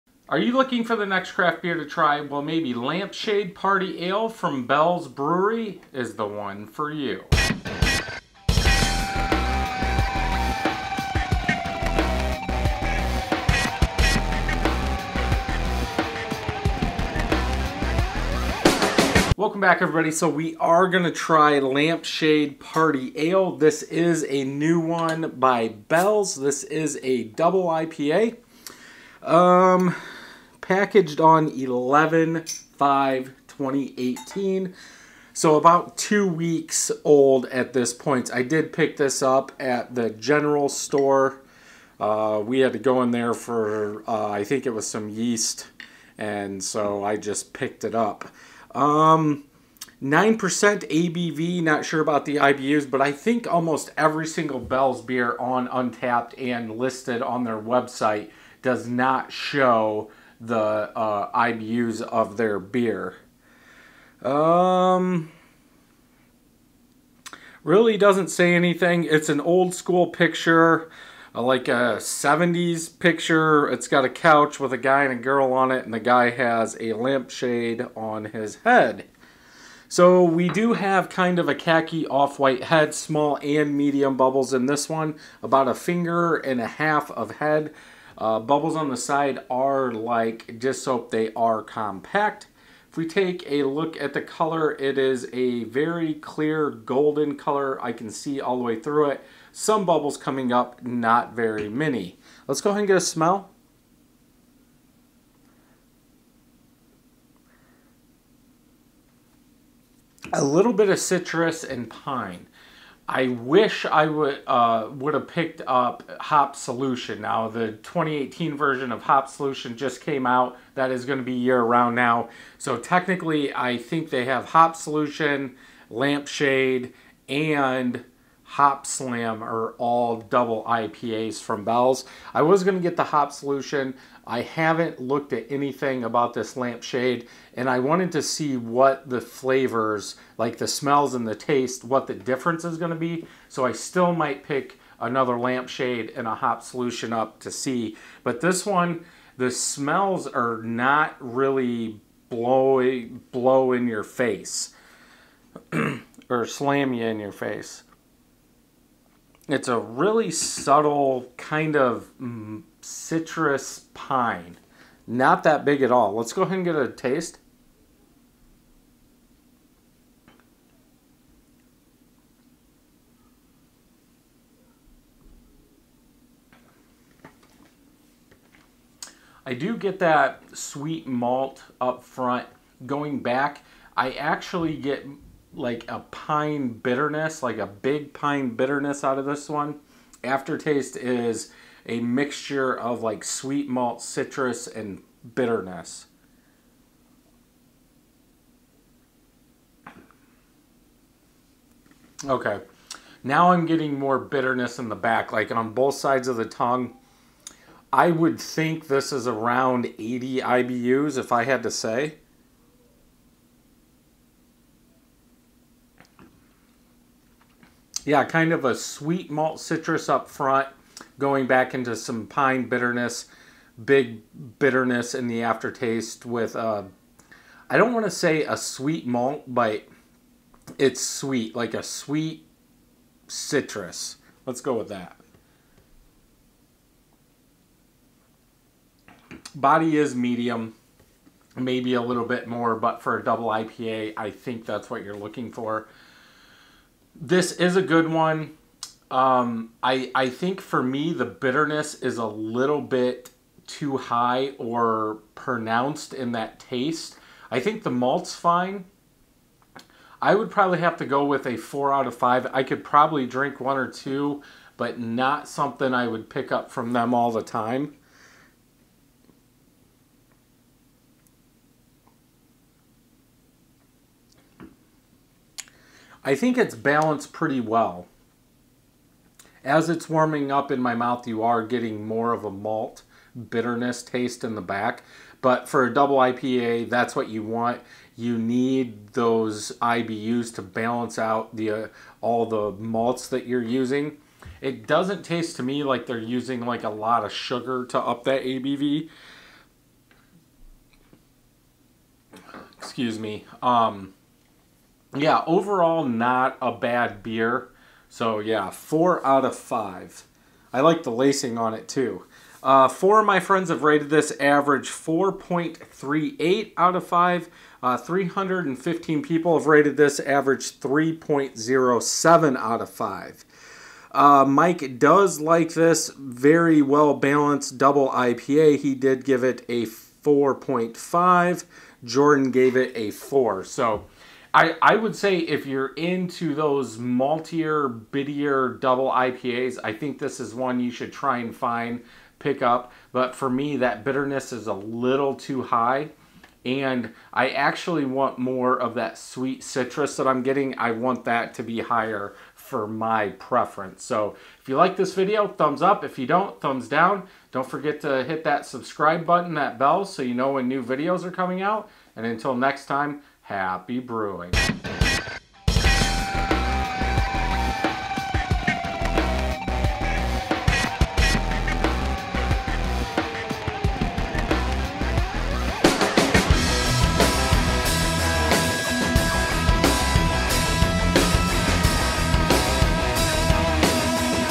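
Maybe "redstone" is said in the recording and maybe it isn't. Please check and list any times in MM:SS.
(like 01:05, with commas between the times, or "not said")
not said.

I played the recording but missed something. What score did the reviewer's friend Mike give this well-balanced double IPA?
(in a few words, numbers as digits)
4.5.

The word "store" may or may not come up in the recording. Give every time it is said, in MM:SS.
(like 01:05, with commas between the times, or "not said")
00:40.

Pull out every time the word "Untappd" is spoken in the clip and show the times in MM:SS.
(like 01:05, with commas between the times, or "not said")
00:55.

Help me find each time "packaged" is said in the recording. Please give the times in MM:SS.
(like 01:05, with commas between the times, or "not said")
00:30.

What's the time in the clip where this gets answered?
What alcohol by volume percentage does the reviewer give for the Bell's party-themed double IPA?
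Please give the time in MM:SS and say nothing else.
00:48.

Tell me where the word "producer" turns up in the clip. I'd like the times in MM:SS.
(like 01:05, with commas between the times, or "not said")
not said.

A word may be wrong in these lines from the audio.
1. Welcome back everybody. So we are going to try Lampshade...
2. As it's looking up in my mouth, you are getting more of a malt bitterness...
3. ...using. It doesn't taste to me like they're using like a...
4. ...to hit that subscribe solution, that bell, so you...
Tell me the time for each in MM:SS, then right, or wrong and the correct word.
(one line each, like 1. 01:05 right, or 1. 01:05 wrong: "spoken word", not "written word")
1. 00:19 right
2. 04:39 wrong: "warming", not "looking"
3. 04:53 right
4. 05:58 wrong: "button", not "solution".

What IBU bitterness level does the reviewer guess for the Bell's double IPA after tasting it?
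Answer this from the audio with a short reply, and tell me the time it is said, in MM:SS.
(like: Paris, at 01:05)
80, at 03:29.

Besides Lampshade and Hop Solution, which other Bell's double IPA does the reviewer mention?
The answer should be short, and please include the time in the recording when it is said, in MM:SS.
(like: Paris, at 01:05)
Hop Slam, at 02:08.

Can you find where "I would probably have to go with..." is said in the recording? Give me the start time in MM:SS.
04:20.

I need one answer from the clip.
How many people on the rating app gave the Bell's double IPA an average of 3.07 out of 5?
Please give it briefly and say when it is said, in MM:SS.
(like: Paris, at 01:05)
315, at 05:17.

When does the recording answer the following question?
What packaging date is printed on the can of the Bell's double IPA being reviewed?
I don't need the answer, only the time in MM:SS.
00:31.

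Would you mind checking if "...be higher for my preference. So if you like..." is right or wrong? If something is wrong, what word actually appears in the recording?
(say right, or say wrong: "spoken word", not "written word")
right.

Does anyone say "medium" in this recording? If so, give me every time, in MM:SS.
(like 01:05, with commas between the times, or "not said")
01:23, 04:00.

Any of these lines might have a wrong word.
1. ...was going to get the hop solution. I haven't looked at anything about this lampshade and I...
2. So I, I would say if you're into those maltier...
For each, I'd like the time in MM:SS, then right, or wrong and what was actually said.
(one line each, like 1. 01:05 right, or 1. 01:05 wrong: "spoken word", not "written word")
1. 02:12 right
2. 05:33 right.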